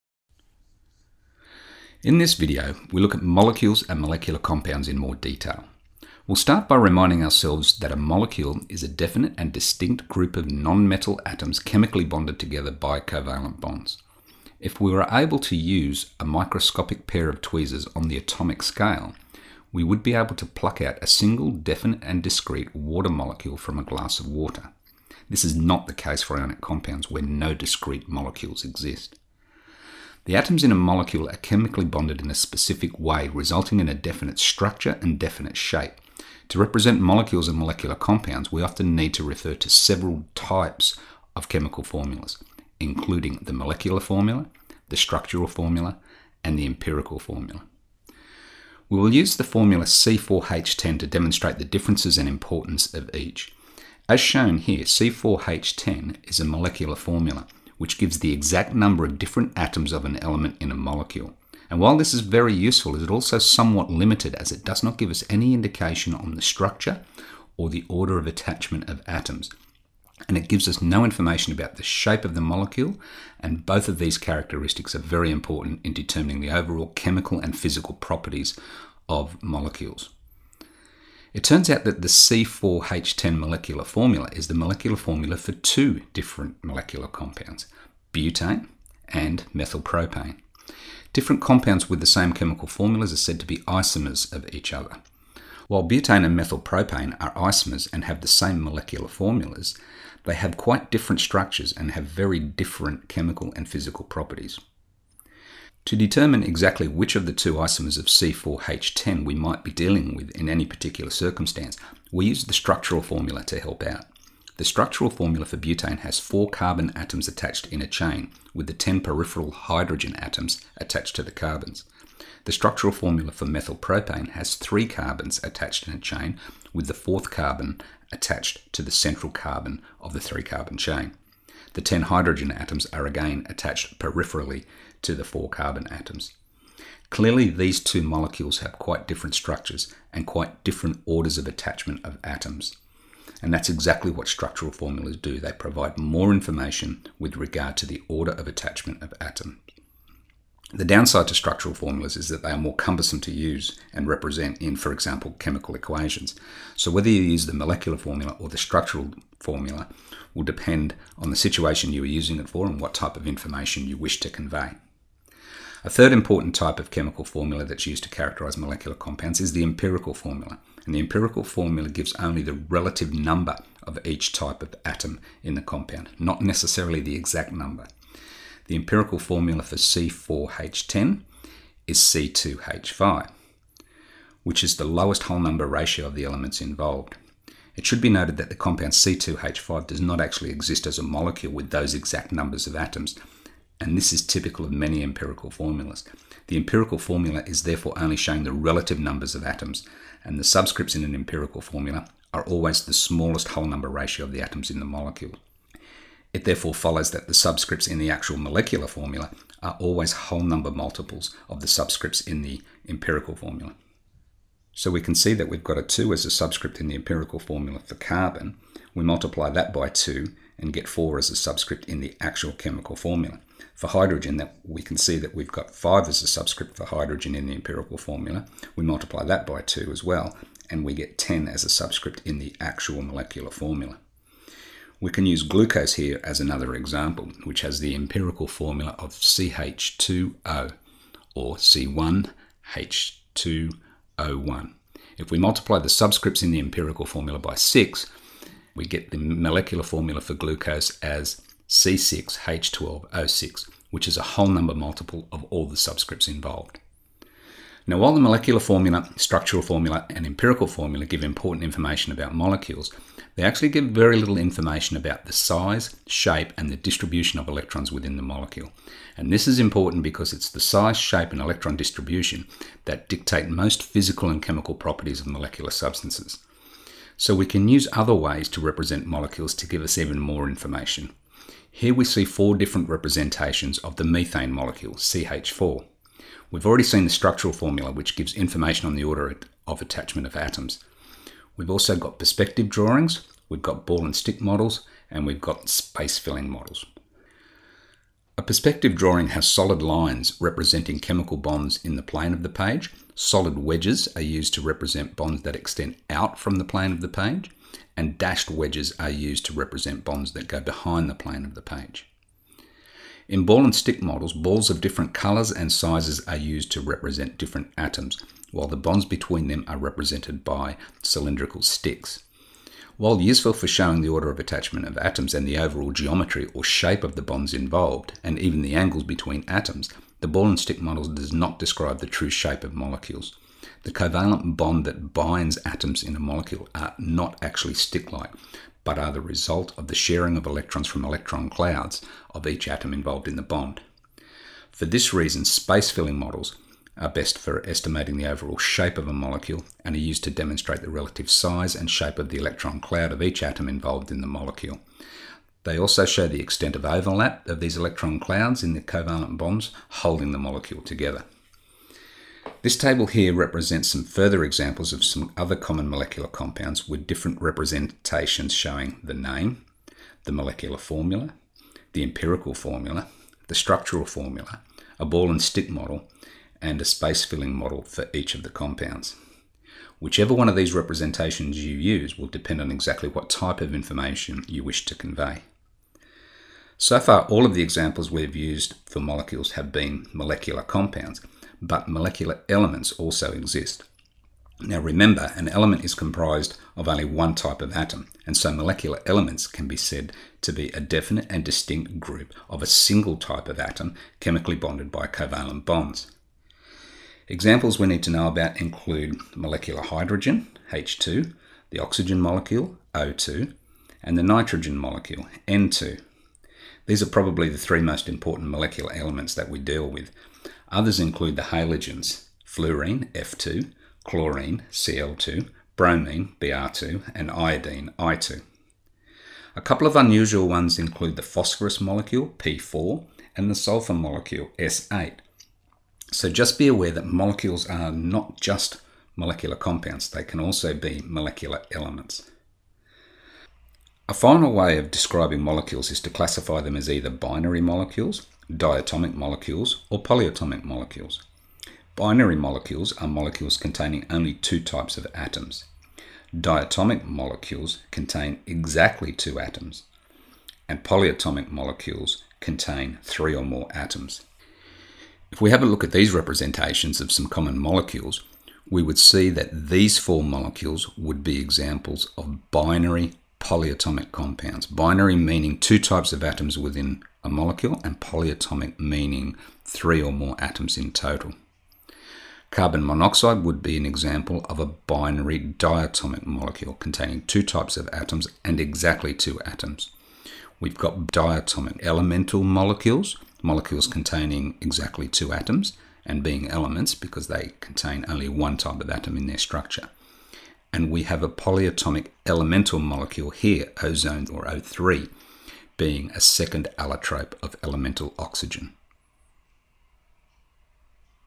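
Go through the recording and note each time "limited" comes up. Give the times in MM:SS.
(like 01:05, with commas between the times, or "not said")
01:03.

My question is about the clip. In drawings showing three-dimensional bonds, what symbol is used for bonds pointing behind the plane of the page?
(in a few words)
dashed wedges.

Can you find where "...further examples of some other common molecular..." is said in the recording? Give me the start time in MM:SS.
06:04.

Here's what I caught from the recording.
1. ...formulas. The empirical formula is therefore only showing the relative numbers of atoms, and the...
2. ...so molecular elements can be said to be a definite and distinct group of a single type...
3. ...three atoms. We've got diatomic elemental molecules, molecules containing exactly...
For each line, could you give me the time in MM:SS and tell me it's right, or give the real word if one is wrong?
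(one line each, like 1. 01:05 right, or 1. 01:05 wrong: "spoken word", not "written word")
1. 03:15 right
2. 06:38 right
3. 08:09 wrong: "two", not "three".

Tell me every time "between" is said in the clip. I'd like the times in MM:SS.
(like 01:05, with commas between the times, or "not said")
05:19, 05:29.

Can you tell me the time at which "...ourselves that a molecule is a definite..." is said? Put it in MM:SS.
00:07.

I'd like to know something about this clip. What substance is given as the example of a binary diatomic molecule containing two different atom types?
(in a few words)
carbon monoxide.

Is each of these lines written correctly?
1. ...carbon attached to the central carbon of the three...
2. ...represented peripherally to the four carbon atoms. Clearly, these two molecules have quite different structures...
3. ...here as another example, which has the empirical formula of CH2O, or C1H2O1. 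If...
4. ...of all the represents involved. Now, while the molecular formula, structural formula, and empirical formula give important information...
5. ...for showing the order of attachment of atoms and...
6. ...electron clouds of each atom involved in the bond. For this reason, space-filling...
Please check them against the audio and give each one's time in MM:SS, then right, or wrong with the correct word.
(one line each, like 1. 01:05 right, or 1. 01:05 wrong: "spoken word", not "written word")
1. 02:07 right
2. 02:13 wrong: "attached", not "represented"
3. 03:55 right
4. 04:15 wrong: "subscripts", not "represents"
5. 05:23 right
6. 05:41 right.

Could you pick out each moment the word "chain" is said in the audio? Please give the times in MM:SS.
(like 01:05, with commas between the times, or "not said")
01:57, 02:05, 02:10.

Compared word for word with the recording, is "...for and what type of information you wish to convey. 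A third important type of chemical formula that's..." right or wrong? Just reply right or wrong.
right.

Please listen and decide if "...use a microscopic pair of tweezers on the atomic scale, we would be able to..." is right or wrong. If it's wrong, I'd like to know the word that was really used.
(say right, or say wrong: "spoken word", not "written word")
right.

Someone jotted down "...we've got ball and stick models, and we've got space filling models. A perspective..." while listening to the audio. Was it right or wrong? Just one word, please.
right.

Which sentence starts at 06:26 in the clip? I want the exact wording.
So far, all of the examples we've used for molecules have been molecular compounds, but molecular elements also exist.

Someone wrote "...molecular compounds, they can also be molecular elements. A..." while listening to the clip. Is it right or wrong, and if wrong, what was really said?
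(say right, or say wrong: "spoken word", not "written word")
right.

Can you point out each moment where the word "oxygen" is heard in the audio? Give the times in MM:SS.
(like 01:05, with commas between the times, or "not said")
06:51, 08:28.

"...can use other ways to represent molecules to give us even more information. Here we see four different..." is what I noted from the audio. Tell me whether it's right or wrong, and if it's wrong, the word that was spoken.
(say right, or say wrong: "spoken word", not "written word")
right.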